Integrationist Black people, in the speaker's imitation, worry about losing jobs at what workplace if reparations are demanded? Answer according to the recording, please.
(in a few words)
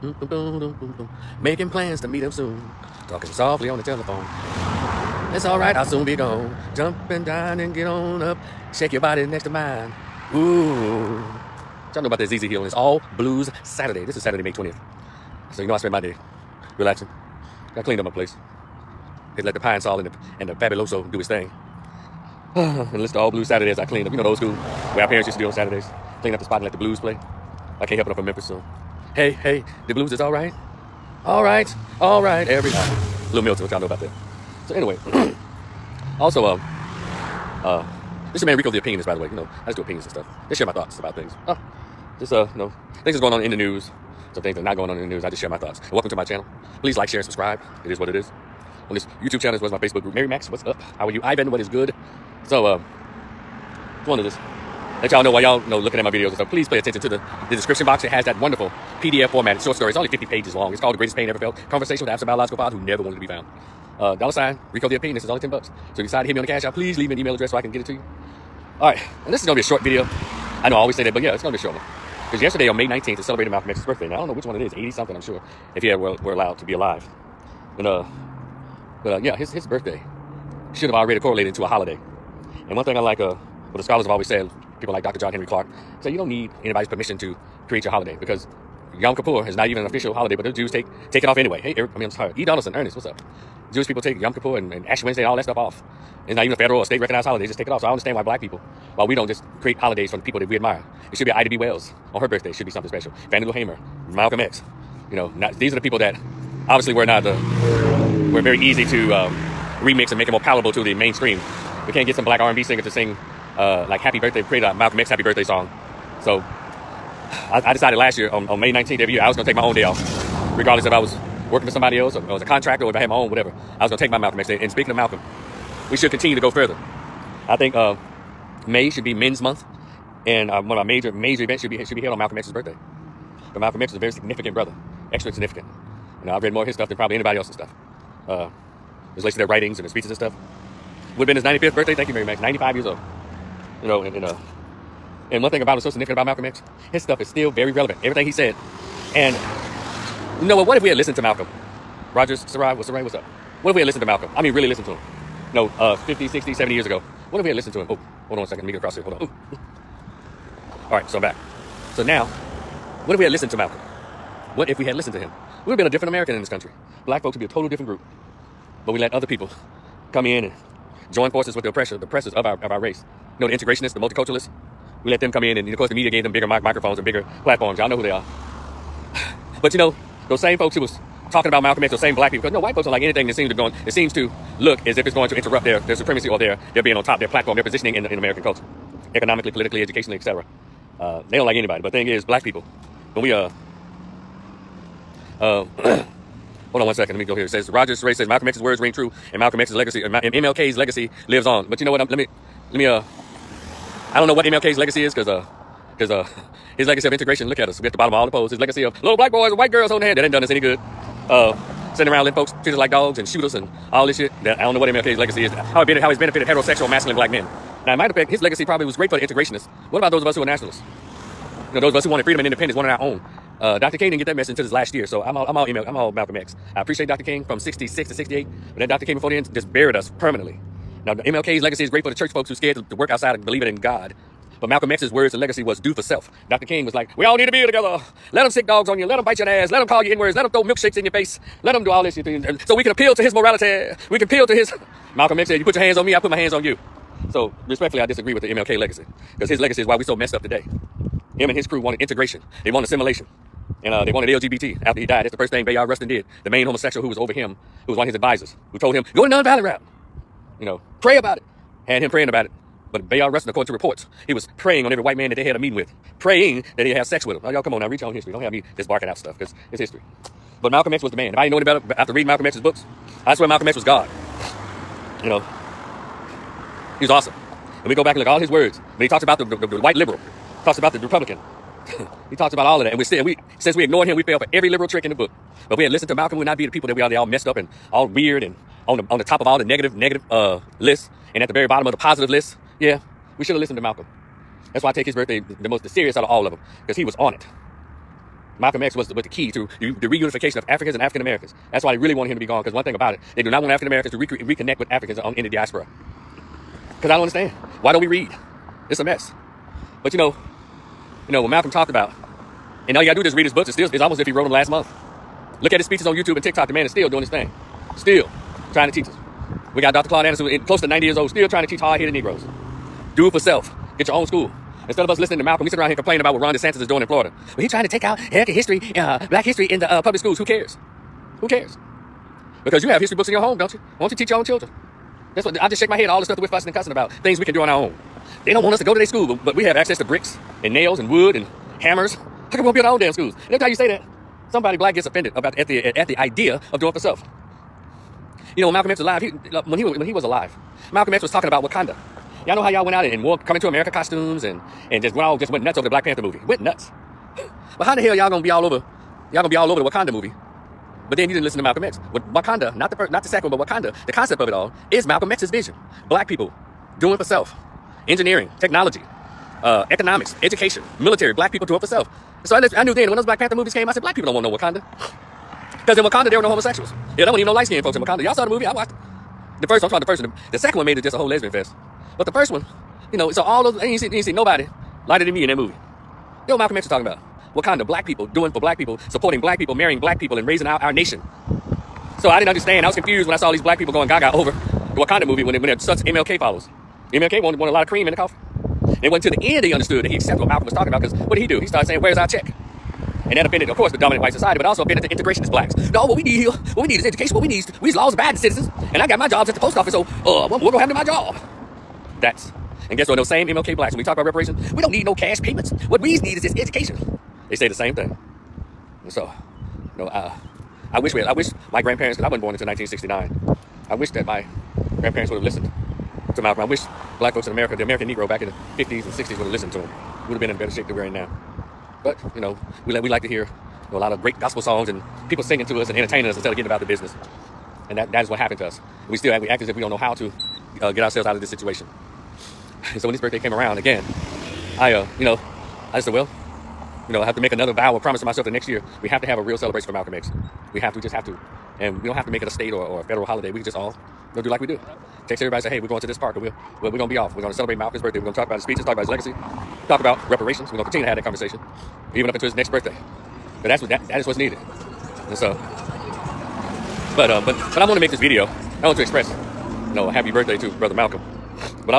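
The post office.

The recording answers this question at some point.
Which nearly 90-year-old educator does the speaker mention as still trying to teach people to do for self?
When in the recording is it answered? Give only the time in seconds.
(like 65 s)
320 s.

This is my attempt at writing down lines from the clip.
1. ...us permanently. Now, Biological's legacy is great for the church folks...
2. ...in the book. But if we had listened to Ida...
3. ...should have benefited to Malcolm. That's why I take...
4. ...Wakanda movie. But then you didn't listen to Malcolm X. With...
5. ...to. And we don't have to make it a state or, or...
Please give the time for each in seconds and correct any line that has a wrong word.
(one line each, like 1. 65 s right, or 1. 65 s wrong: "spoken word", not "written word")
1. 229 s wrong: "MLK", not "Biological"
2. 285 s wrong: "Malcolm", not "Ida"
3. 293 s wrong: "listened", not "benefited"
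4. 359 s right
5. 451 s right.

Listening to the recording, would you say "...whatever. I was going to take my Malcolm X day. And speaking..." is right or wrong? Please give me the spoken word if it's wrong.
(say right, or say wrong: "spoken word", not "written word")
right.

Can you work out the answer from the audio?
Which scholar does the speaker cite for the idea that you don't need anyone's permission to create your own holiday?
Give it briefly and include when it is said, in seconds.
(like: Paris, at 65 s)
John Henrik Clarke, at 85 s.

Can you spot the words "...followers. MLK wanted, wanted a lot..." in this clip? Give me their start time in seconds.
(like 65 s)
396 s.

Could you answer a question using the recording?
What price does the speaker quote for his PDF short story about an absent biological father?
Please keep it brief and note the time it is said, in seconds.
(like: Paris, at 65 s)
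$10, at 65 s.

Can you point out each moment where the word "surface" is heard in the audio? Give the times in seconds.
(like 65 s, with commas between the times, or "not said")
not said.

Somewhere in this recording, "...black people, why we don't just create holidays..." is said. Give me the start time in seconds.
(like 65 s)
98 s.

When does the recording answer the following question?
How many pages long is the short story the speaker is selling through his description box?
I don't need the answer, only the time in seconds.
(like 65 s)
60 s.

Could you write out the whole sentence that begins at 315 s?
Look at his speeches on YouTube and TikTok.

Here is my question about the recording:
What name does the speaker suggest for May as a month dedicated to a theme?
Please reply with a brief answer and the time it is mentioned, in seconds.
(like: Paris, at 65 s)
Men's Month, at 129 s.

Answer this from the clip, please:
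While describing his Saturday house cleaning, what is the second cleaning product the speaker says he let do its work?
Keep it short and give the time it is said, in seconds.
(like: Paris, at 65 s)
Fabuloso, at 20 s.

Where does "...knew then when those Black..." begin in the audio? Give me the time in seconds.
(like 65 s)
372 s.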